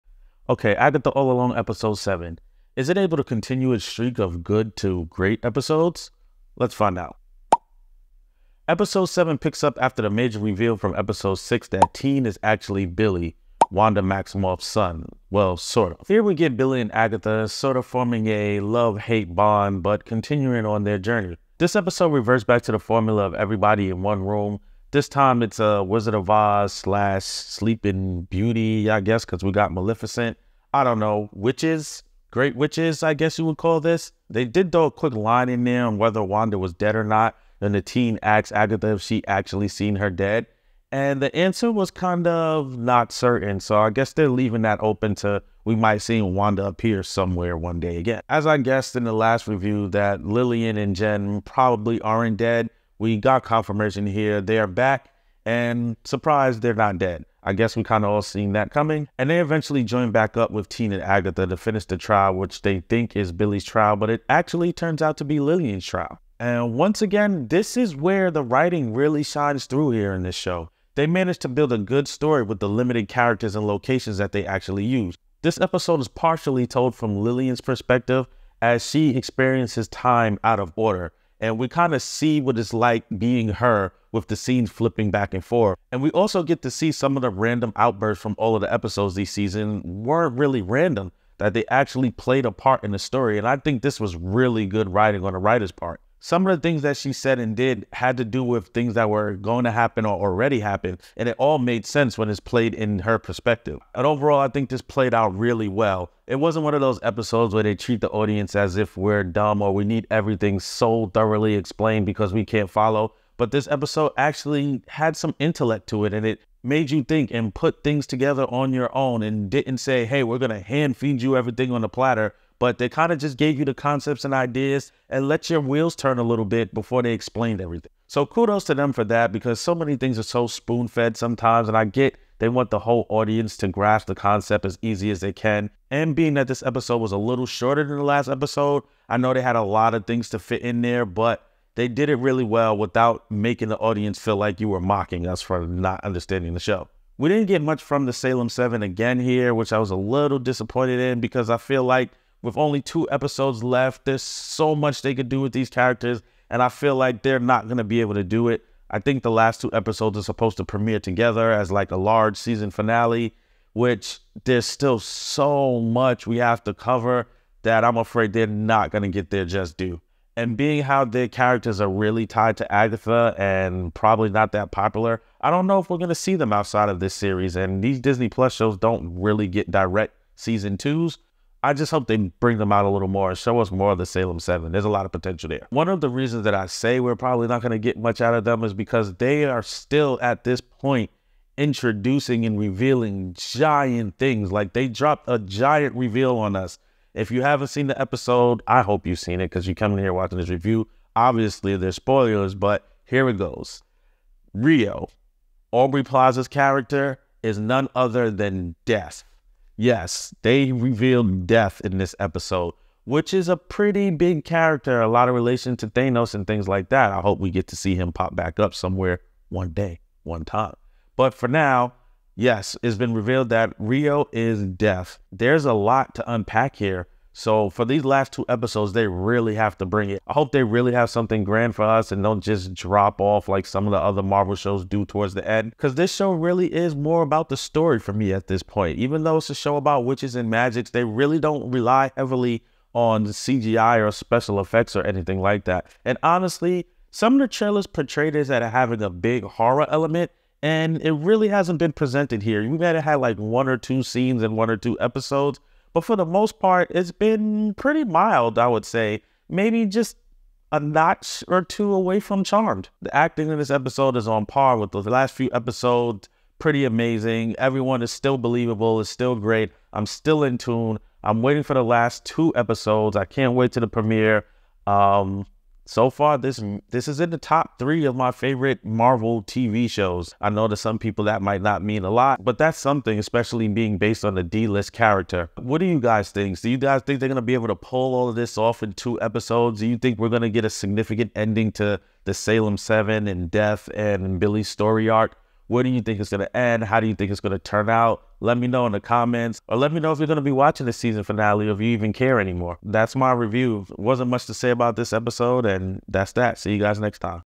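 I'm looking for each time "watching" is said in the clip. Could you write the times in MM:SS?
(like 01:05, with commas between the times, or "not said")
03:20, 05:00.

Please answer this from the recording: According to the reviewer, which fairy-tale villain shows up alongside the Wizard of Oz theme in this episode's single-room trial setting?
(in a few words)
Maleficent.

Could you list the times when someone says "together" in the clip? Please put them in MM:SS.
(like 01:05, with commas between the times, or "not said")
01:58, 02:40.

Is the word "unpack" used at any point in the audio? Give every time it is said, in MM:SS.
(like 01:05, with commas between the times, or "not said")
03:46.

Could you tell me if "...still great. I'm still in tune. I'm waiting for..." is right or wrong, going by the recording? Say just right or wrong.
right.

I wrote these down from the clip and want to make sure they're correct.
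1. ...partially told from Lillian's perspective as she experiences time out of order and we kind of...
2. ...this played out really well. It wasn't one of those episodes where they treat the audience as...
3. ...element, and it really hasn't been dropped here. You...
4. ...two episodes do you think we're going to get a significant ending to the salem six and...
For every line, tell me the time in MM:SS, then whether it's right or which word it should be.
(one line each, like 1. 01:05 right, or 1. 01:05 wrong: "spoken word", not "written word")
1. 01:16 right
2. 01:44 right
3. 04:09 wrong: "presented", not "dropped"
4. 04:48 wrong: "seven", not "six".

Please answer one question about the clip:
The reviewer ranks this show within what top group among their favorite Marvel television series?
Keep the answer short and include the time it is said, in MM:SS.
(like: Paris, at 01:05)
Top three, at 04:37.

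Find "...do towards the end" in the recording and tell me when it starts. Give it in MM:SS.
03:54.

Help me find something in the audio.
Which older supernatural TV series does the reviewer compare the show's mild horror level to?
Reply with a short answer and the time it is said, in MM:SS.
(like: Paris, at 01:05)
Charmed, at 04:22.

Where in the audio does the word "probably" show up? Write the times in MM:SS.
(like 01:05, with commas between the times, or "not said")
00:51, 02:53, 03:07.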